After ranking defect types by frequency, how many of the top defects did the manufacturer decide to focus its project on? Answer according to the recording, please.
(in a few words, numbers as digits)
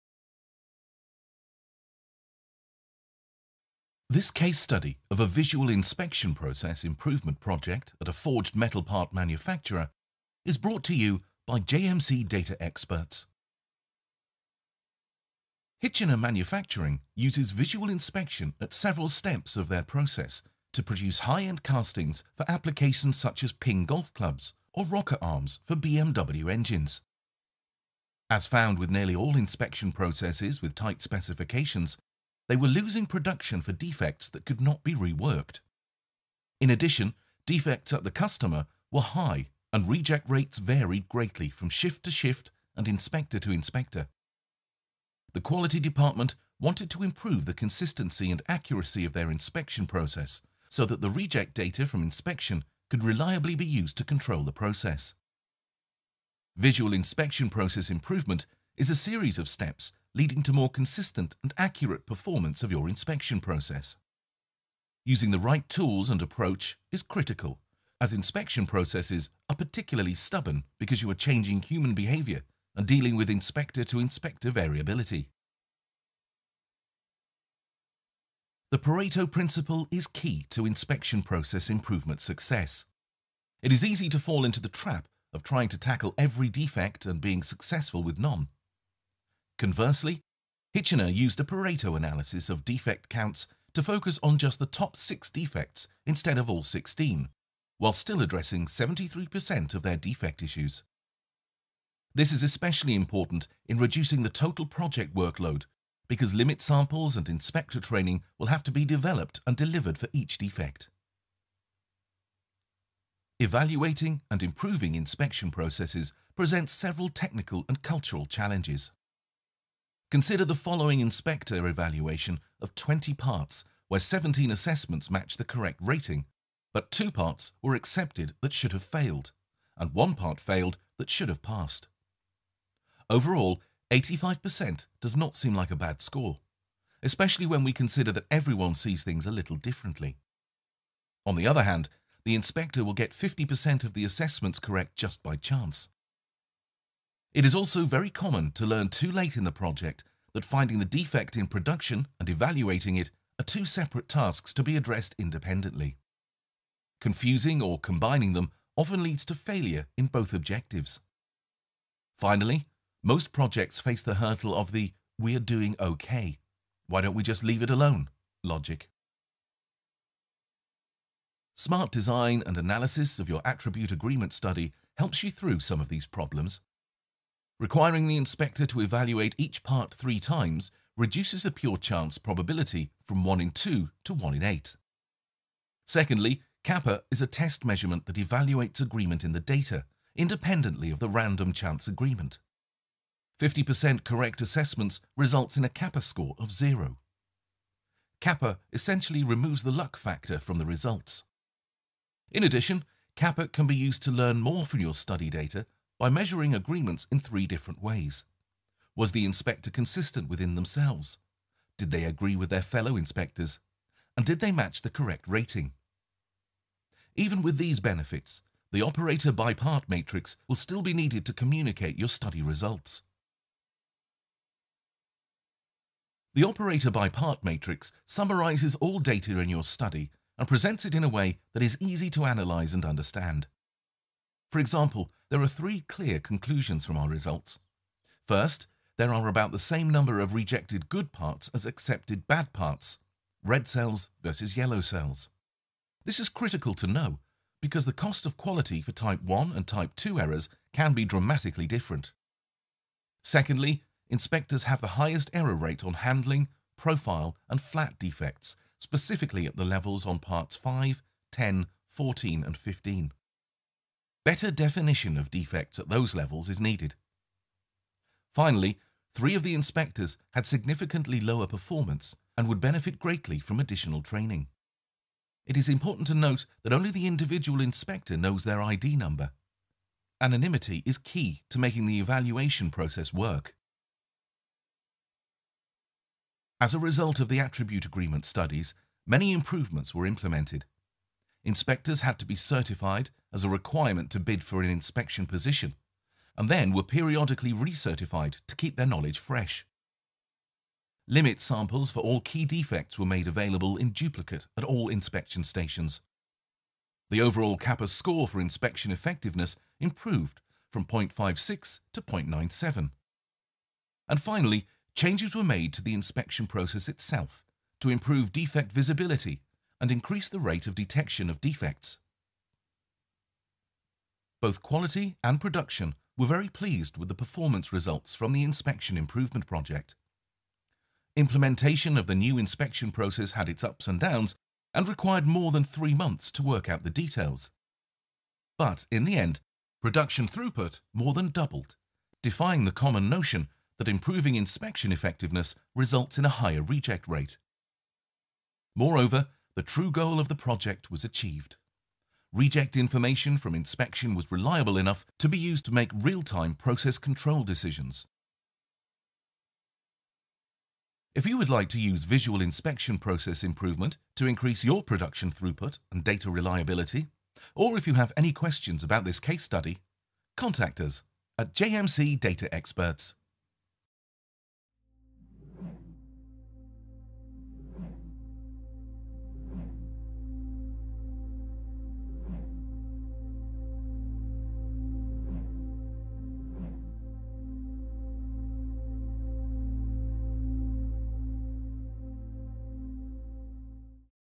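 6.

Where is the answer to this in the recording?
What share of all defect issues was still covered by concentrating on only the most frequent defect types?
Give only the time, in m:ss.
1:38.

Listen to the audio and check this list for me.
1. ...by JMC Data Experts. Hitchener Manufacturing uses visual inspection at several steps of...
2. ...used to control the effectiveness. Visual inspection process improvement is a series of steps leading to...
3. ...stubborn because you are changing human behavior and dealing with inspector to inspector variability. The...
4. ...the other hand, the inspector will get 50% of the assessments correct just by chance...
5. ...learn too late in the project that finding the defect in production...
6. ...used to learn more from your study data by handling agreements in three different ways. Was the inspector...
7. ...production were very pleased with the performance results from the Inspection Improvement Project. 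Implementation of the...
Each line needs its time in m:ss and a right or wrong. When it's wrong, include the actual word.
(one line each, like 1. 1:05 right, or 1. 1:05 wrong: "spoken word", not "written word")
1. 0:11 right
2. 0:53 wrong: "process", not "effectiveness"
3. 1:10 right
4. 2:21 right
5. 2:28 right
6. 3:23 wrong: "measuring", not "handling"
7. 5:25 right.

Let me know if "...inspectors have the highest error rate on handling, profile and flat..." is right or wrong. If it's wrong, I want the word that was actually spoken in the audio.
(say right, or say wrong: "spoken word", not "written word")
right.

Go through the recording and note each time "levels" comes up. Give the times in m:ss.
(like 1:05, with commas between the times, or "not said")
4:19, 4:26.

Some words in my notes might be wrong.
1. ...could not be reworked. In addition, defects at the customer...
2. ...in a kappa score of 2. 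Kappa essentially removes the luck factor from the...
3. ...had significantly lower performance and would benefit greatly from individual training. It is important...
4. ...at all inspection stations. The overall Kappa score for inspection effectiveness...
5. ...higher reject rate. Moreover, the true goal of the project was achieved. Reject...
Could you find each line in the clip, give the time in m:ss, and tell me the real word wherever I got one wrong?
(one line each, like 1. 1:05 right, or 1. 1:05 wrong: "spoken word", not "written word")
1. 0:34 right
2. 3:15 wrong: "0", not "2"
3. 4:30 wrong: "additional", not "individual"
4. 5:04 right
5. 5:46 right.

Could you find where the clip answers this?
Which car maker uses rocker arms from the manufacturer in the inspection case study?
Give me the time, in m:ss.
0:25.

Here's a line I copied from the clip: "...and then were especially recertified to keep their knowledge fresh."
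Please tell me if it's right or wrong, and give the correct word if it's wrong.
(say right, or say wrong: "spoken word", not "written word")
wrong: "periodically", not "especially".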